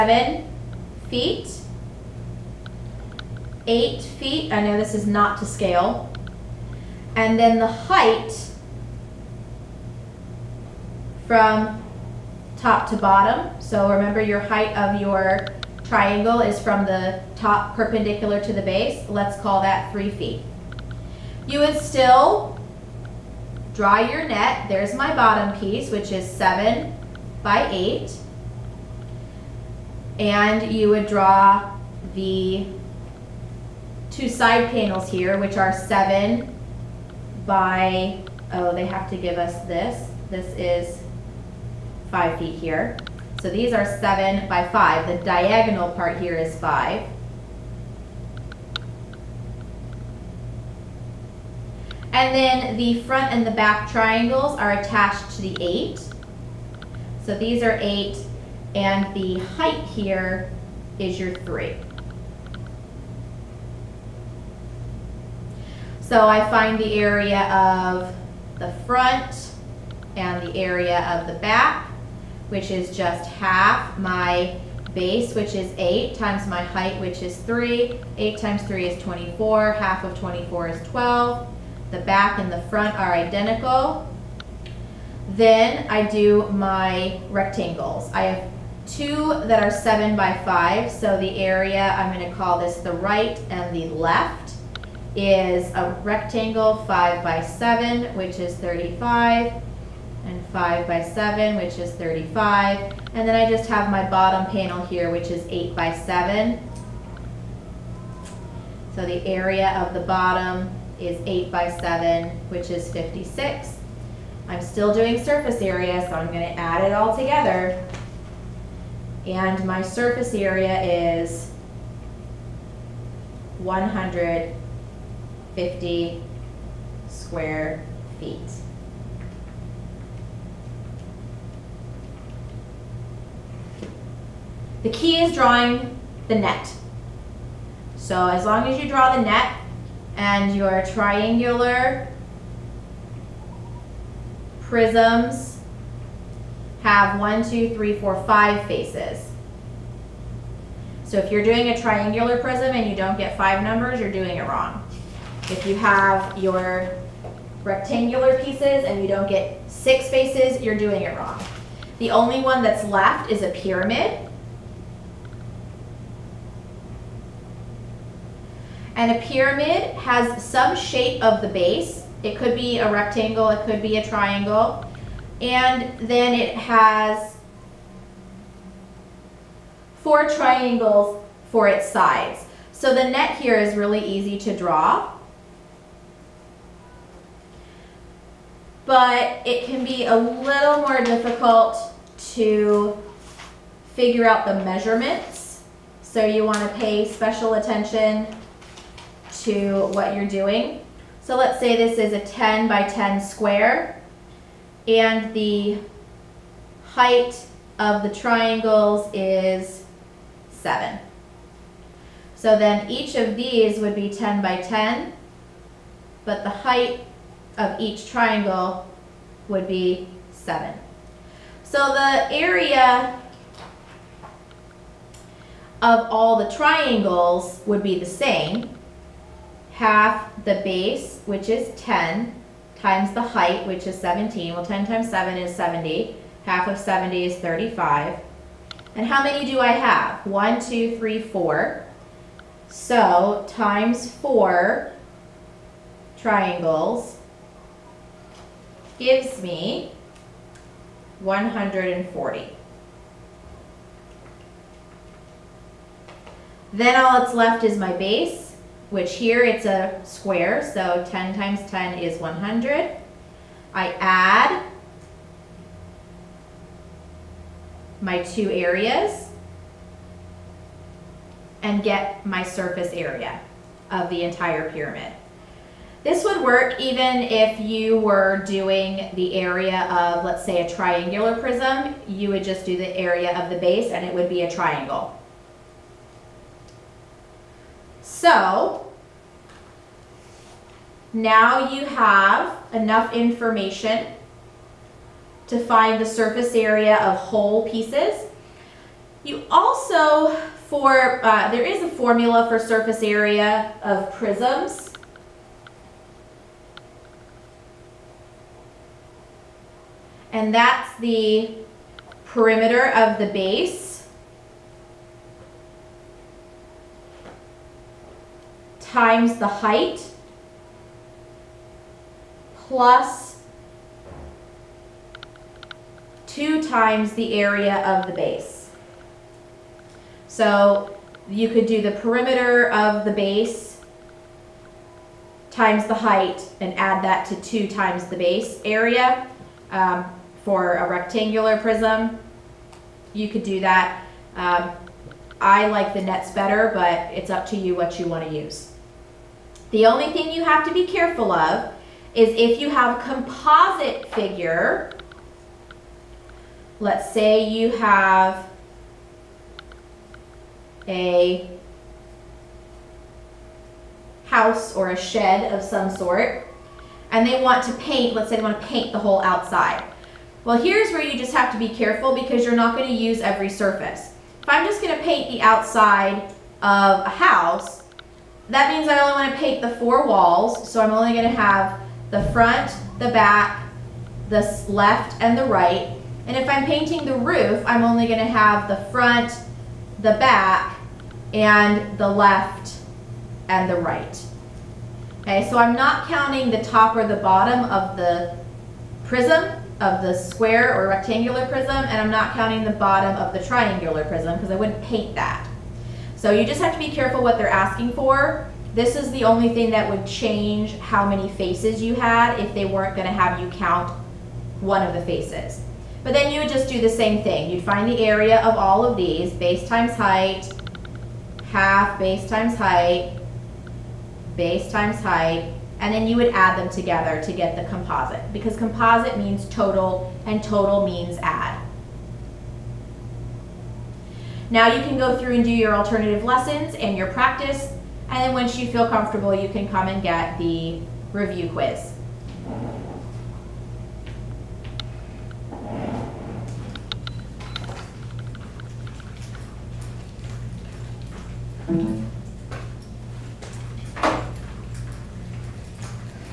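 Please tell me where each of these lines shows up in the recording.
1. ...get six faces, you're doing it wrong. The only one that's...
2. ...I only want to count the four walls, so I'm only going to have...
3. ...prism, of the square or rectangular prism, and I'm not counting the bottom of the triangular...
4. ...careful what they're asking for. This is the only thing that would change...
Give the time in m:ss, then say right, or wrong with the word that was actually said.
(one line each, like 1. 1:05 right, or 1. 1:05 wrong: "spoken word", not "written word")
1. 2:39 right
2. 6:18 wrong: "paint", not "count"
3. 6:39 right
4. 6:46 right.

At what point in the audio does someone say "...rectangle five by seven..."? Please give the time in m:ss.
1:36.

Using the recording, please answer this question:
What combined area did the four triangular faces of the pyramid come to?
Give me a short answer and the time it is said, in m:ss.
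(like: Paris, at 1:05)
140, at 4:11.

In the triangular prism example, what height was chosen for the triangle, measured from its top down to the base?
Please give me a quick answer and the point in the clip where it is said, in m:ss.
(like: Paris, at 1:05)
3 feet, at 0:19.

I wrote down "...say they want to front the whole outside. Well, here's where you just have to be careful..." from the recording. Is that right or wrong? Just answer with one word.
wrong.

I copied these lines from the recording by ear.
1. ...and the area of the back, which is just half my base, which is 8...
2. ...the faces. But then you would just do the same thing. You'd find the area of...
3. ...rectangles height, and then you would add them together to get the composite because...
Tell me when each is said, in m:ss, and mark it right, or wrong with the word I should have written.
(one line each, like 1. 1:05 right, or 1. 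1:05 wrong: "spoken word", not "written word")
1. 1:10 right
2. 6:54 right
3. 7:04 wrong: "times", not "rectangles".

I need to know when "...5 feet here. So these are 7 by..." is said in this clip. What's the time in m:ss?
0:42.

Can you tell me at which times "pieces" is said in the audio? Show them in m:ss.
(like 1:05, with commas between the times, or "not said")
0:25, 2:38, 4:57.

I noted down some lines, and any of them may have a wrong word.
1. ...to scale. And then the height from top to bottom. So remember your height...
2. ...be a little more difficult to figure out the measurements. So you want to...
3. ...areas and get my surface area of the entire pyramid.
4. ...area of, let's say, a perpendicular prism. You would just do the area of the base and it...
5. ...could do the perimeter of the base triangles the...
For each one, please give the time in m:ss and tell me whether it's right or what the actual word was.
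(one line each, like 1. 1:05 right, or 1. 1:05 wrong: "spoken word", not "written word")
1. 0:05 right
2. 3:09 right
3. 4:28 right
4. 4:39 wrong: "triangular", not "perpendicular"
5. 5:31 wrong: "times", not "triangles".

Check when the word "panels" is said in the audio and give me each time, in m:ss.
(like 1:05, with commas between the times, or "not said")
0:34, 1:44.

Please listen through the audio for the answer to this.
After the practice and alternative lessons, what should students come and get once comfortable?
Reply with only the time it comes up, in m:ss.
7:21.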